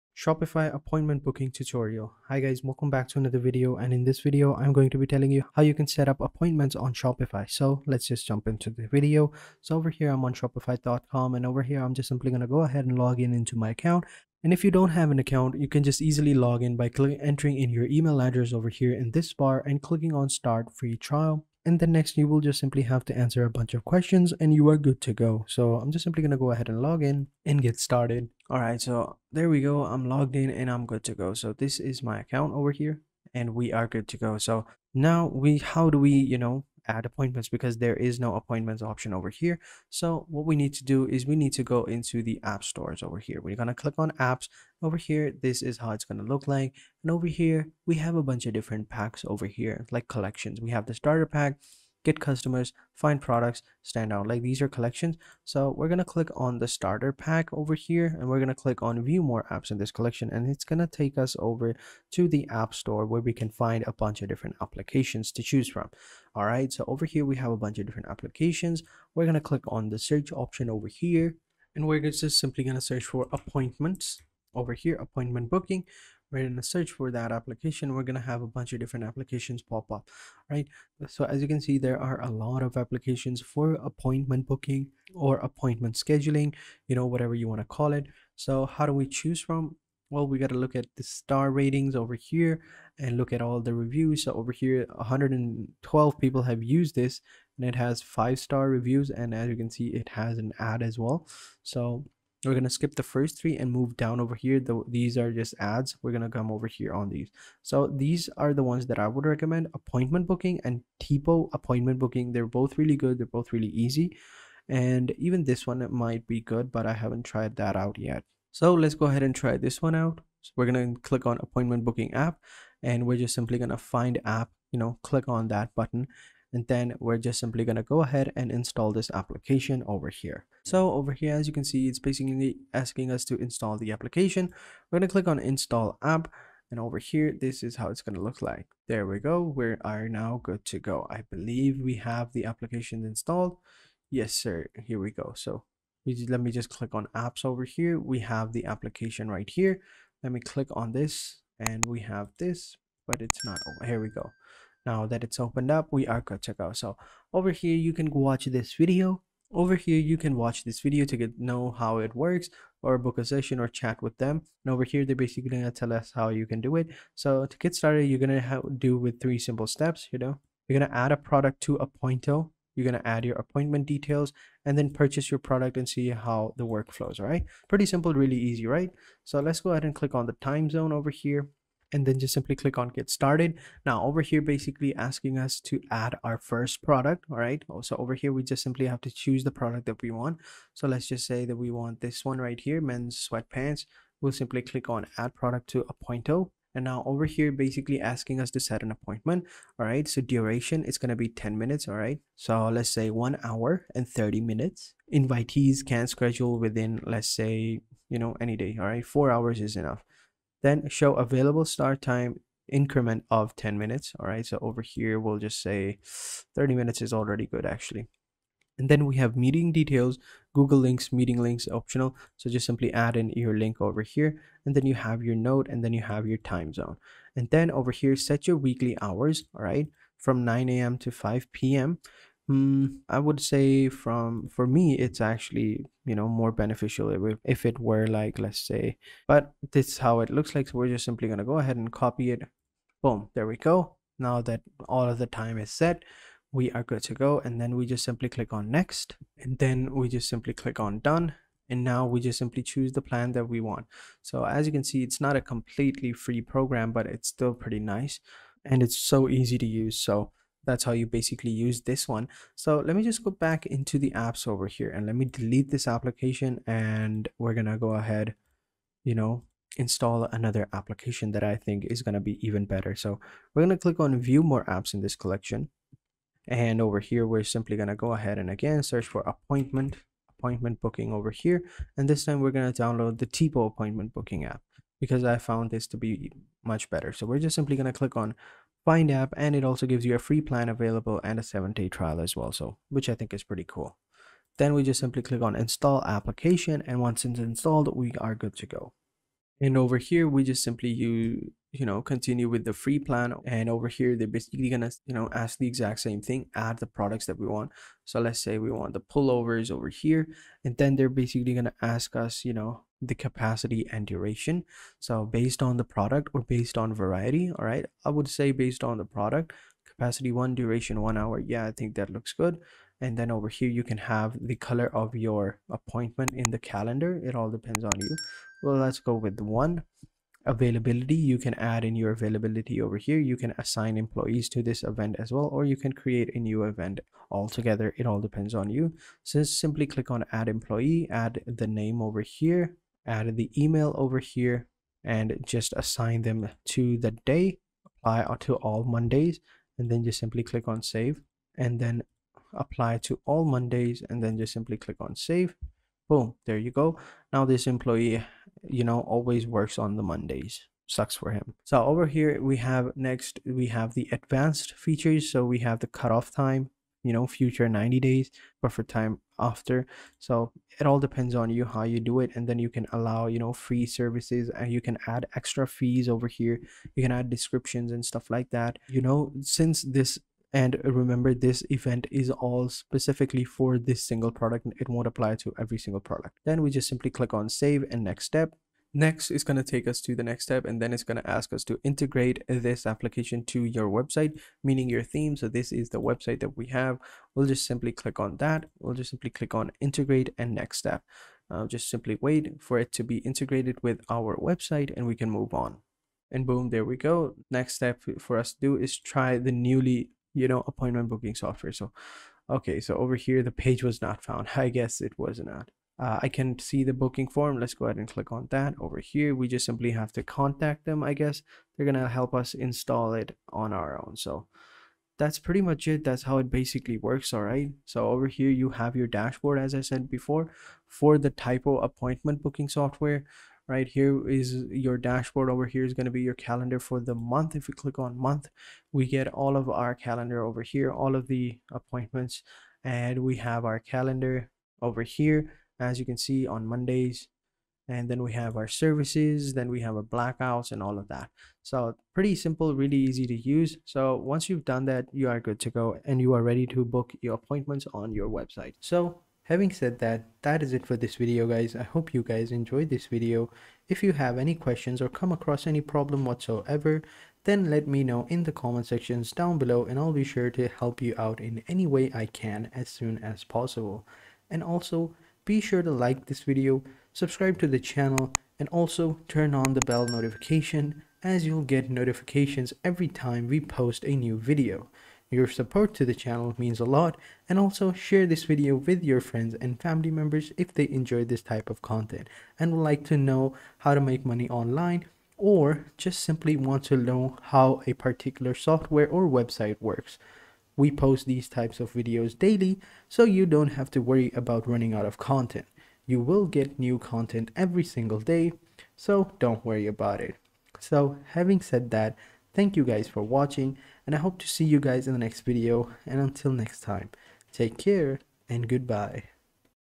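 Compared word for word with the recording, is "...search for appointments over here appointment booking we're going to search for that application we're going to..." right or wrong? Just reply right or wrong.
right.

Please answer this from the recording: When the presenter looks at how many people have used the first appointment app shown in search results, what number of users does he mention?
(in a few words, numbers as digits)
112.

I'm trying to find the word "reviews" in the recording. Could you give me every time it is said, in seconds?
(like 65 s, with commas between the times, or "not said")
93 s, 98 s.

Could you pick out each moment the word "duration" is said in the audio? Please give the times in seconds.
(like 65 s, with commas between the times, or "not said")
200 s, 314 s, 320 s.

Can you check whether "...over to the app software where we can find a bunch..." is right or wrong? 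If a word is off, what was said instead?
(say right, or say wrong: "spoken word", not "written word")
wrong: "store", not "software".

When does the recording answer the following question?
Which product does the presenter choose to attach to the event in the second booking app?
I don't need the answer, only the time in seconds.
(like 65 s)
308 s.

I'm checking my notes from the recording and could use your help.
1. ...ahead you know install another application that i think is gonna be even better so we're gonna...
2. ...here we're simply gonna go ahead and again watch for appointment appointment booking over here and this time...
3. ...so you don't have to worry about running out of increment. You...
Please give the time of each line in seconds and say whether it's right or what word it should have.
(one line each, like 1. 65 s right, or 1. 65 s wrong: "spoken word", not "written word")
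1. 267 s right
2. 276 s wrong: "search", not "watch"
3. 503 s wrong: "content", not "increment".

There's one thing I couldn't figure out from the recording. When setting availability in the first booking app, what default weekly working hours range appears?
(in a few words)
9 a.m. to 5 p.m.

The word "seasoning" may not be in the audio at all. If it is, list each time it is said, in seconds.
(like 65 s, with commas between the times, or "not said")
not said.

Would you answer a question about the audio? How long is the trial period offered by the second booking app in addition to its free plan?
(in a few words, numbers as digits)
7 days.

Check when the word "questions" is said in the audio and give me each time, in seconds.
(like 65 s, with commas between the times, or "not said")
23 s, 464 s.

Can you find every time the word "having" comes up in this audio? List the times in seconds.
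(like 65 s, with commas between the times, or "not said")
459 s, 511 s.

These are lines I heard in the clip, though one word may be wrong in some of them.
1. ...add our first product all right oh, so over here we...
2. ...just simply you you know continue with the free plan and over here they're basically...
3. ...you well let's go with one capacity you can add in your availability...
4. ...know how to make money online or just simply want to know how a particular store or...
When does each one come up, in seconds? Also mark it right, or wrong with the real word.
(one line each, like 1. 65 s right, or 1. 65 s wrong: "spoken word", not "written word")
1. 185 s right
2. 300 s right
3. 327 s wrong: "availability", not "capacity"
4. 493 s wrong: "software", not "store".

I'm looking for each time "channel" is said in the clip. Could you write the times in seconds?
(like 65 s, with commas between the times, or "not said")
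477 s, 486 s.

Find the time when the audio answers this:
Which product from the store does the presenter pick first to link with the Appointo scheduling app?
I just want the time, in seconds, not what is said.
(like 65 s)
192 s.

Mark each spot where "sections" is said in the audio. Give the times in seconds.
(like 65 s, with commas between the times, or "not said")
468 s.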